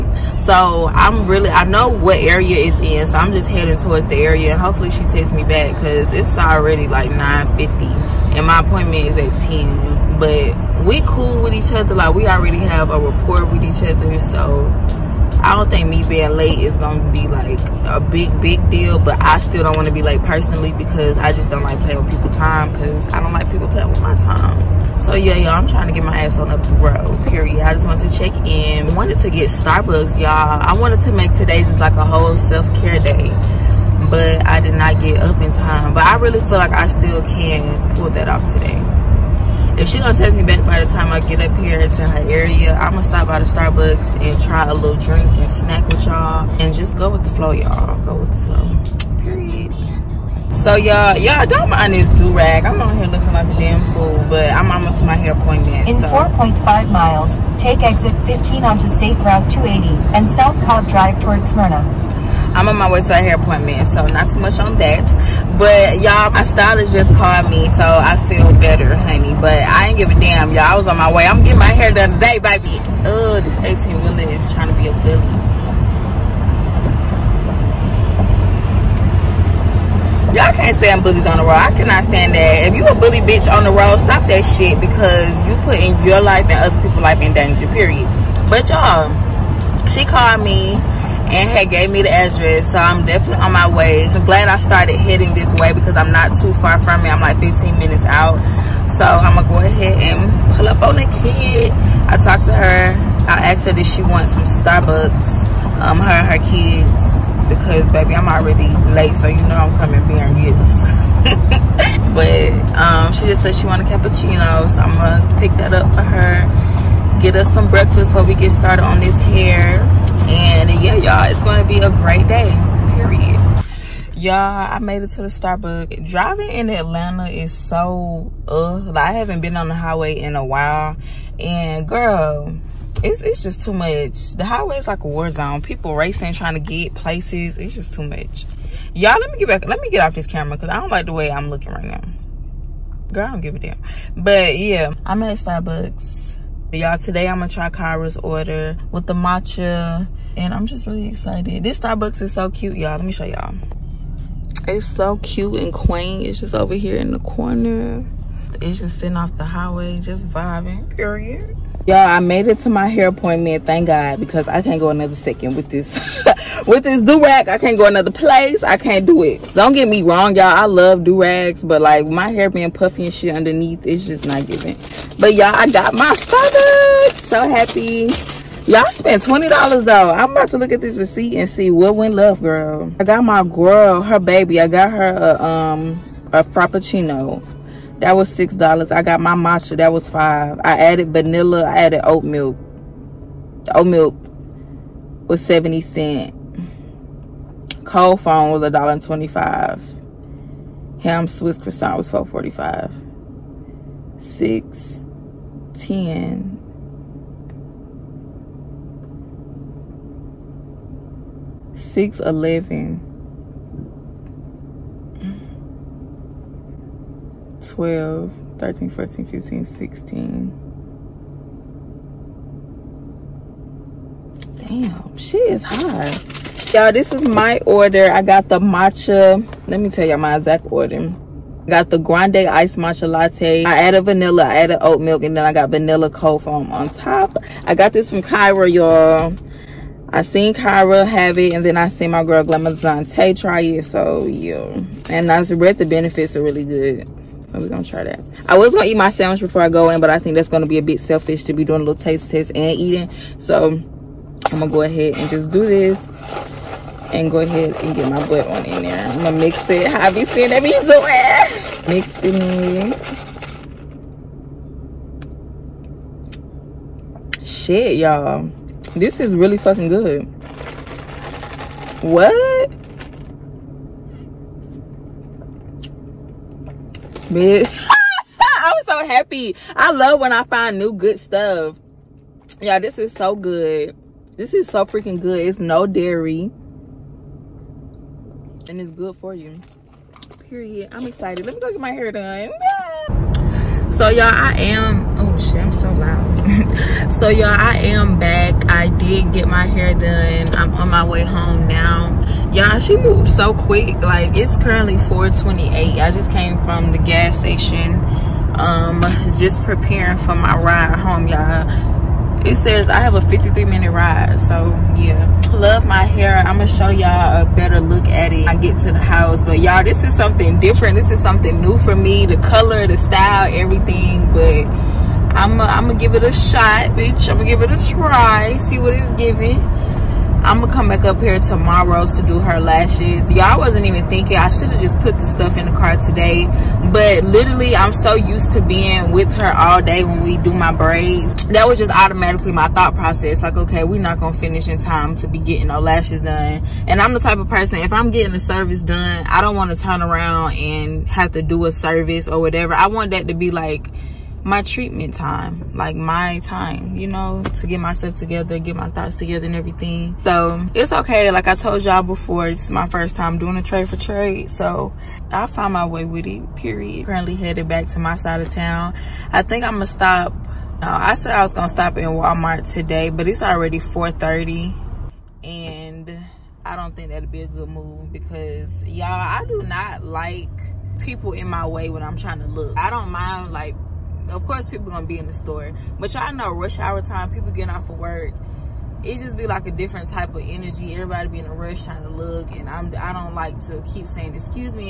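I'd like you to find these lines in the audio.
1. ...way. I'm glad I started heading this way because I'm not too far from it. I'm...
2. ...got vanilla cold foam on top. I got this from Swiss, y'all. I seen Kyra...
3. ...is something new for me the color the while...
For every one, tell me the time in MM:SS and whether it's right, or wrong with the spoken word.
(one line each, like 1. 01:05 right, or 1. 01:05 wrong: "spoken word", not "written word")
1. 01:33 right
2. 03:55 wrong: "Kyra", not "Swiss"
3. 05:21 wrong: "style", not "while".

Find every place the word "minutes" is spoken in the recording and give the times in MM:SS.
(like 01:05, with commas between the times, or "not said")
01:37, 05:13.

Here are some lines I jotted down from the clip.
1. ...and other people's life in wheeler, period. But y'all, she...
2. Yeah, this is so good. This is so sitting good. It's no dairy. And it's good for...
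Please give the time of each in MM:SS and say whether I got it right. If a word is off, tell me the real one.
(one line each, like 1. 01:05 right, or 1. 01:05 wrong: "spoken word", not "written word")
1. 01:26 wrong: "danger", not "wheeler"
2. 04:42 wrong: "freaking", not "sitting".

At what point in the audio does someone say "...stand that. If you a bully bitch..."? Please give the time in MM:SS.
01:22.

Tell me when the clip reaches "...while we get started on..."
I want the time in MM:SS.
01:58.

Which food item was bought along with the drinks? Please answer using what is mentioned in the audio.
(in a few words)
Ham Swiss croissant.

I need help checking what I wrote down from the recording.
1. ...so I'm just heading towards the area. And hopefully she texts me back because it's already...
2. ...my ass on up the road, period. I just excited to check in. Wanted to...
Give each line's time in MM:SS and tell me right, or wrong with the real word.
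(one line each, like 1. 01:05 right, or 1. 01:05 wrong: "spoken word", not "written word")
1. 00:03 right
2. 00:26 wrong: "wanted", not "excited".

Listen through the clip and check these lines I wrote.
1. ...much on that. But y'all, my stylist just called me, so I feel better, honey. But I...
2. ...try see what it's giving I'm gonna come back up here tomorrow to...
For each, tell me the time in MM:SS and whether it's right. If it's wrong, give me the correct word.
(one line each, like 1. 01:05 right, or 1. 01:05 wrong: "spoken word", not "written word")
1. 01:04 right
2. 05:27 right.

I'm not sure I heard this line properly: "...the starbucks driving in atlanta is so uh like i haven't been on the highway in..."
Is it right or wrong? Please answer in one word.
right.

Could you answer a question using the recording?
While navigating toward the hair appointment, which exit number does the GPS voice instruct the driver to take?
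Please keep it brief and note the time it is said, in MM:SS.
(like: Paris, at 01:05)
15, at 00:57.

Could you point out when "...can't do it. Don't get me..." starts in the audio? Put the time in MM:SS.
02:48.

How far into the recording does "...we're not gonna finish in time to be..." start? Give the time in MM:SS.
05:43.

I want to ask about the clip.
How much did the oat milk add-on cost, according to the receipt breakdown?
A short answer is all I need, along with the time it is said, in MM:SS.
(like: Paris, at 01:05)
70 cents, at 03:13.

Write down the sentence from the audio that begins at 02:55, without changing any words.
But y'all, I got my Starbucks.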